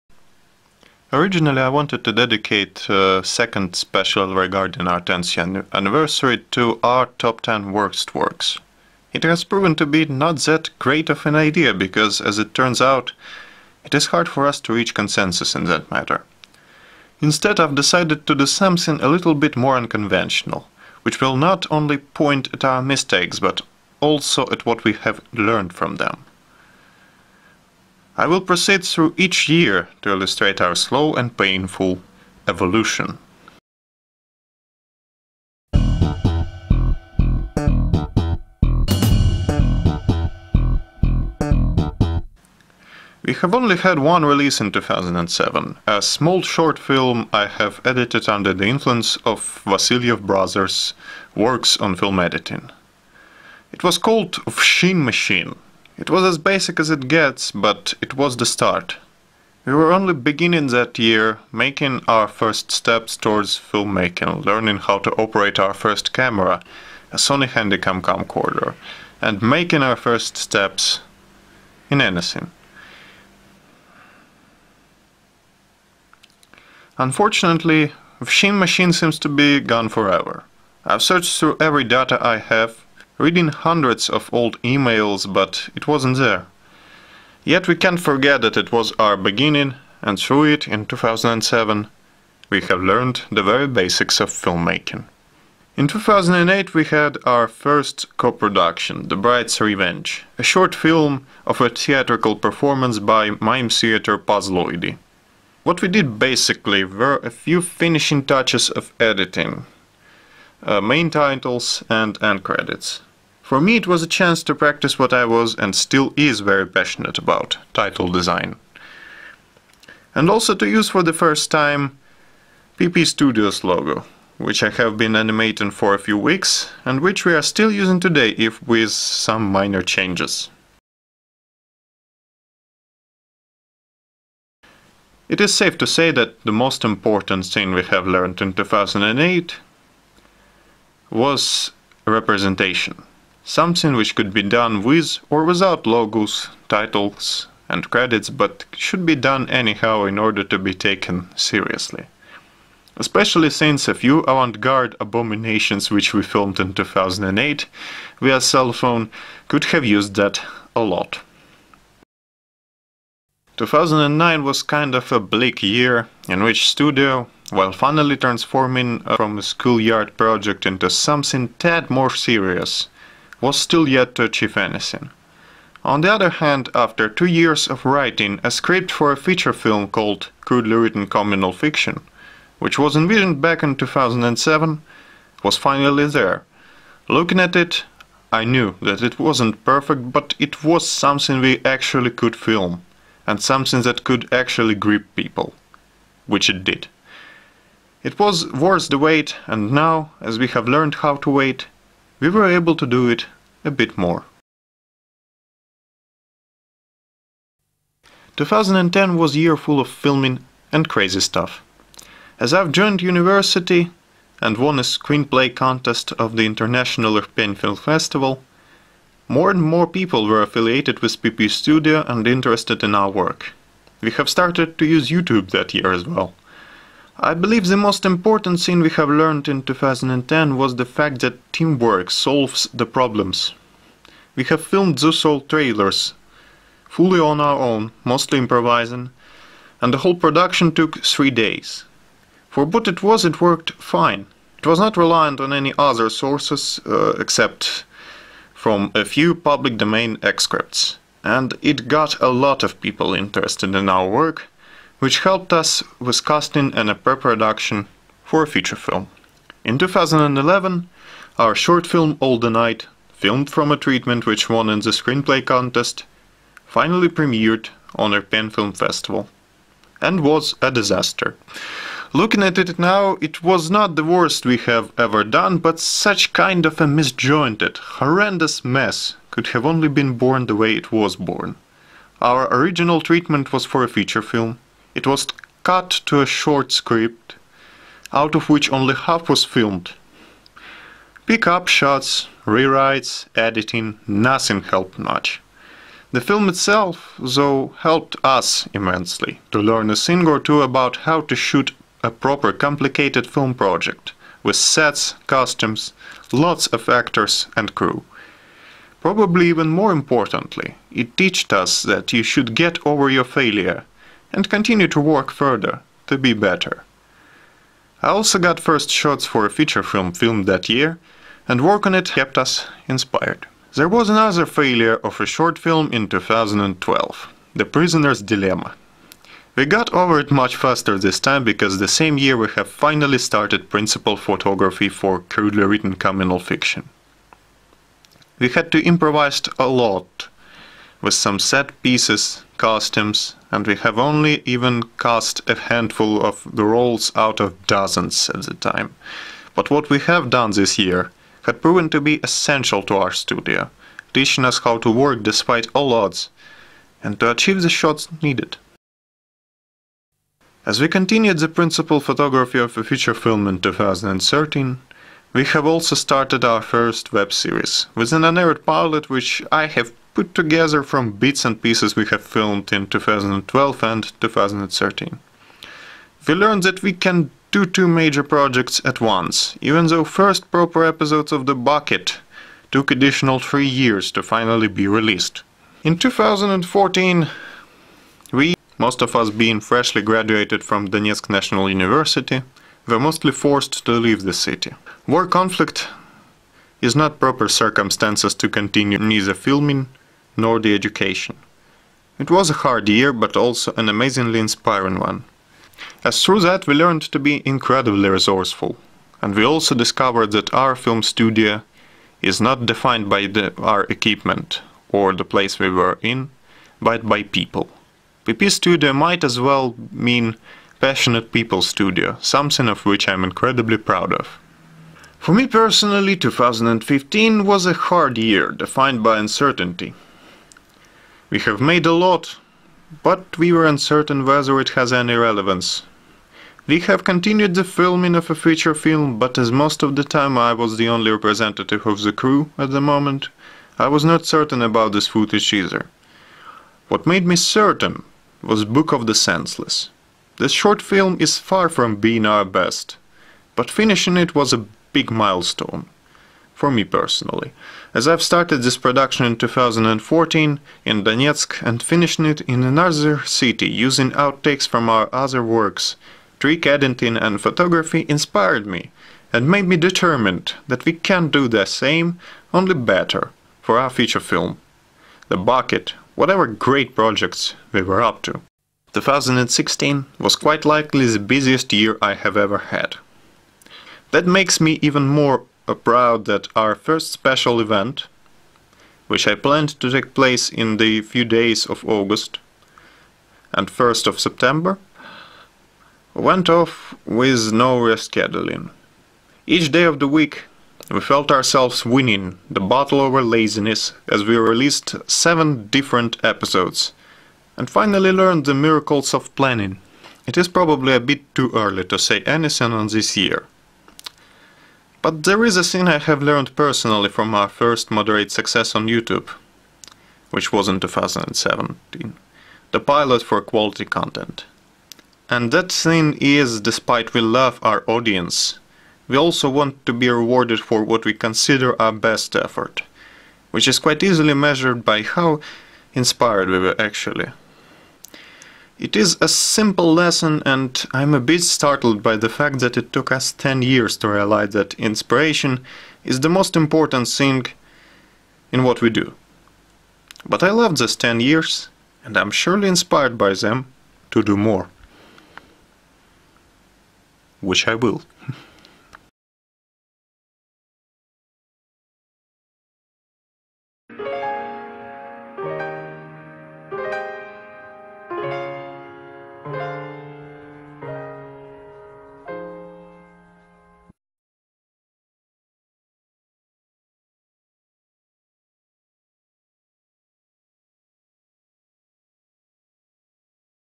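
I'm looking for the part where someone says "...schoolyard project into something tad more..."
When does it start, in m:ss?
2:49.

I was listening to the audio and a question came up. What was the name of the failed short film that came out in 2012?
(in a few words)
The Prisoner's Dilemma.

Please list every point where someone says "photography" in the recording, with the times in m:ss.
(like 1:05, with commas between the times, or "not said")
5:34, 6:01, 7:47.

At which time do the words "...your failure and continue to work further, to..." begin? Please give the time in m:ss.
5:13.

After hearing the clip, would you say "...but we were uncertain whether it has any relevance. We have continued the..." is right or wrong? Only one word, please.
right.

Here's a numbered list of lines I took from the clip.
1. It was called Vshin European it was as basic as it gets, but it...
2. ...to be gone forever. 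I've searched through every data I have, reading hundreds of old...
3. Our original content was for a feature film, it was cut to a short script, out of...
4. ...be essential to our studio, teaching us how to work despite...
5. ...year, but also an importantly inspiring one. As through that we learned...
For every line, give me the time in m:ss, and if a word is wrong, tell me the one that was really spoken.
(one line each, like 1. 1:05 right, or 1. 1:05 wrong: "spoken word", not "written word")
1. 0:53 wrong: "Machine", not "European"
2. 1:19 right
3. 4:42 wrong: "treatment", not "content"
4. 5:51 right
5. 6:42 wrong: "amazingly", not "importantly".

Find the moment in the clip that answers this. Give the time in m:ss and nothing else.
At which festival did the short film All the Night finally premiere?
4:28.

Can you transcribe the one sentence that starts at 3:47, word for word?
I believe the most important thing we have learned in 2010 was the fact that teamwork solves the problems.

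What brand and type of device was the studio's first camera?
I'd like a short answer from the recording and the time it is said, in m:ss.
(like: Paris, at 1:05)
Sony Handycam, at 1:07.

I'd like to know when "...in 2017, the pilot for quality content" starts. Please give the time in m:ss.
8:40.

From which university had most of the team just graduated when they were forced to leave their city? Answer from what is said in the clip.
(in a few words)
Donetsk National University.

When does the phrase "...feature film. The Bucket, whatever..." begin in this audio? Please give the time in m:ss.
7:53.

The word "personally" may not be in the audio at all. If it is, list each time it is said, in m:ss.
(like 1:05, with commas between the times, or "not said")
7:05, 7:36, 8:36.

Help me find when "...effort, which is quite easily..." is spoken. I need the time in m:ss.
8:52.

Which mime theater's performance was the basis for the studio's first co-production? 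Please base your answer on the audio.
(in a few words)
Pazloidi.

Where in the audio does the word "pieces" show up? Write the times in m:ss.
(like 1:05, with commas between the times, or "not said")
5:41, 6:11.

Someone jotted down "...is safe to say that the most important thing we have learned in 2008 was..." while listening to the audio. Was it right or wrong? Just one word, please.
right.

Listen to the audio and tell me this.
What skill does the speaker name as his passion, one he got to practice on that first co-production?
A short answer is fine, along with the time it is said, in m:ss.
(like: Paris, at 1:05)
Title design, at 1:57.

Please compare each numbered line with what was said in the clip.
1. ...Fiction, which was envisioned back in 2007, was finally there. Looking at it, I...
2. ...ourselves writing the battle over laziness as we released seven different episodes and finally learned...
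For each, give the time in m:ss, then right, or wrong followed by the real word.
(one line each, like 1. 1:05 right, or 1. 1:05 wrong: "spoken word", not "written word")
1. 3:01 right
2. 8:21 wrong: "winning", not "writing".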